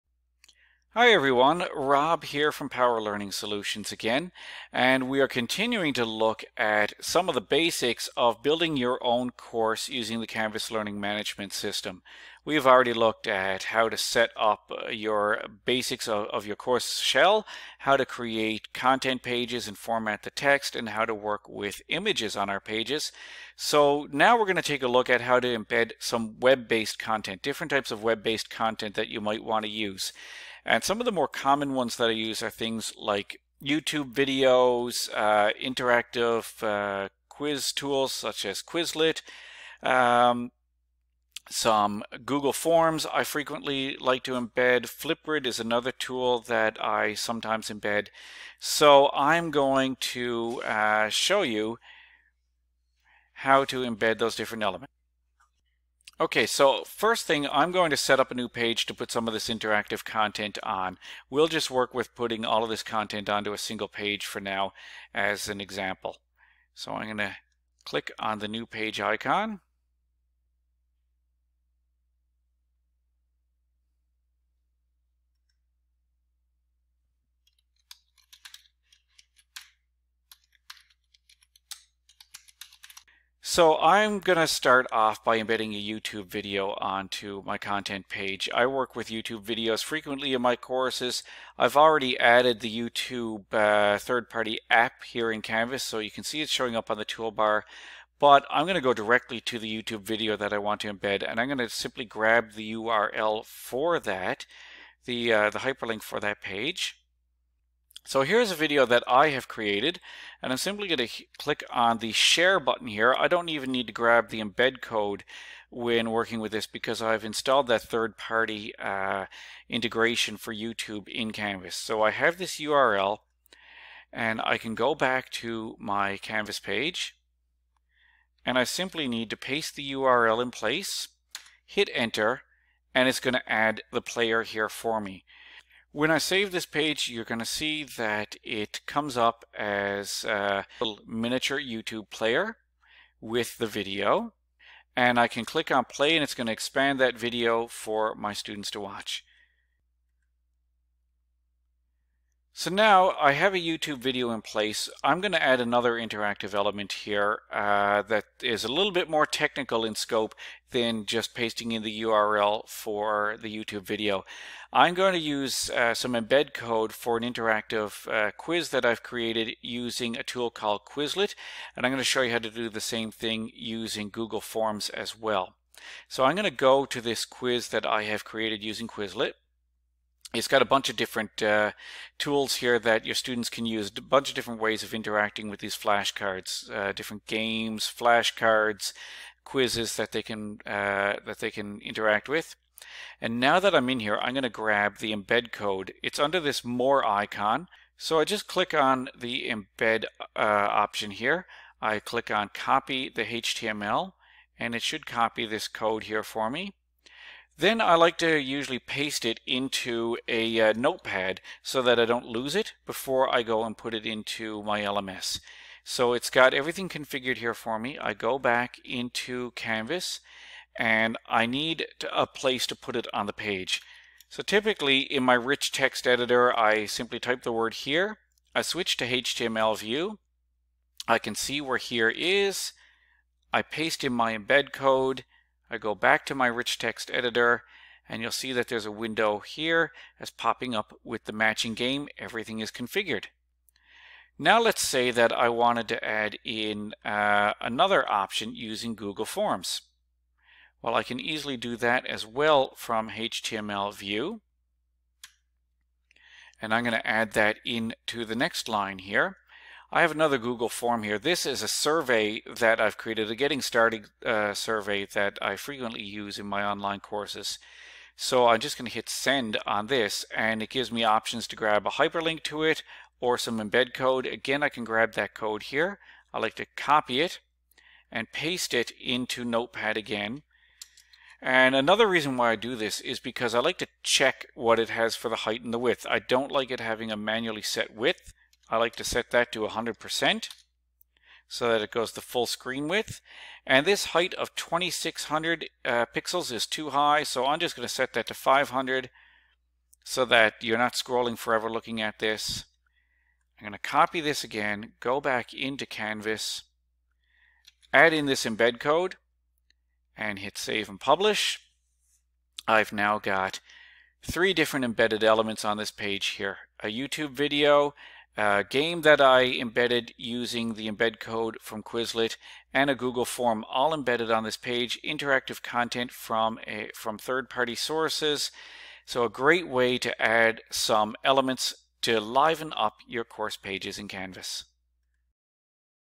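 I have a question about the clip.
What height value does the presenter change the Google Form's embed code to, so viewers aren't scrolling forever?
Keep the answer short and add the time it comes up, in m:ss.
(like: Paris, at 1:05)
500, at 4:58.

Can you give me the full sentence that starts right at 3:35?
So it's got everything configured here for me.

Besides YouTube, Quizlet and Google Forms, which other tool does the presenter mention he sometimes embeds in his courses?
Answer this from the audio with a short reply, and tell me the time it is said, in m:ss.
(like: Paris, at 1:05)
Flipgrid, at 0:44.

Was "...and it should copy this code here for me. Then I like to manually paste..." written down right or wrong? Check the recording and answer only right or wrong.
wrong.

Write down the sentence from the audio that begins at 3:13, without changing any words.
And now that I'm in here, I'm going to grab the embed code.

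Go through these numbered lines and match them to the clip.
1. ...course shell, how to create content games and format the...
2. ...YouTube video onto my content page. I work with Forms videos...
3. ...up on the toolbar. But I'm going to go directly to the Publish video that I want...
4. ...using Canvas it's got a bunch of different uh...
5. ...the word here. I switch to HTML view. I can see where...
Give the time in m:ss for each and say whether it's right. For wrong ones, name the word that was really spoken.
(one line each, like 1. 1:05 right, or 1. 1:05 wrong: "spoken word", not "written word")
1. 0:16 wrong: "pages", not "games"
2. 1:25 wrong: "YouTube", not "Forms"
3. 1:36 wrong: "YouTube", not "Publish"
4. 2:58 wrong: "Quizlet", not "Canvas"
5. 3:47 right.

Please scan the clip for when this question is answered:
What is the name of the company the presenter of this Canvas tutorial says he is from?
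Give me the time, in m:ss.
0:02.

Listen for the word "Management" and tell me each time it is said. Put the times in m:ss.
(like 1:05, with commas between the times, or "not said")
0:10.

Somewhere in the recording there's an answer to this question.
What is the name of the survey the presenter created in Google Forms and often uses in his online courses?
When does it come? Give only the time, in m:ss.
4:23.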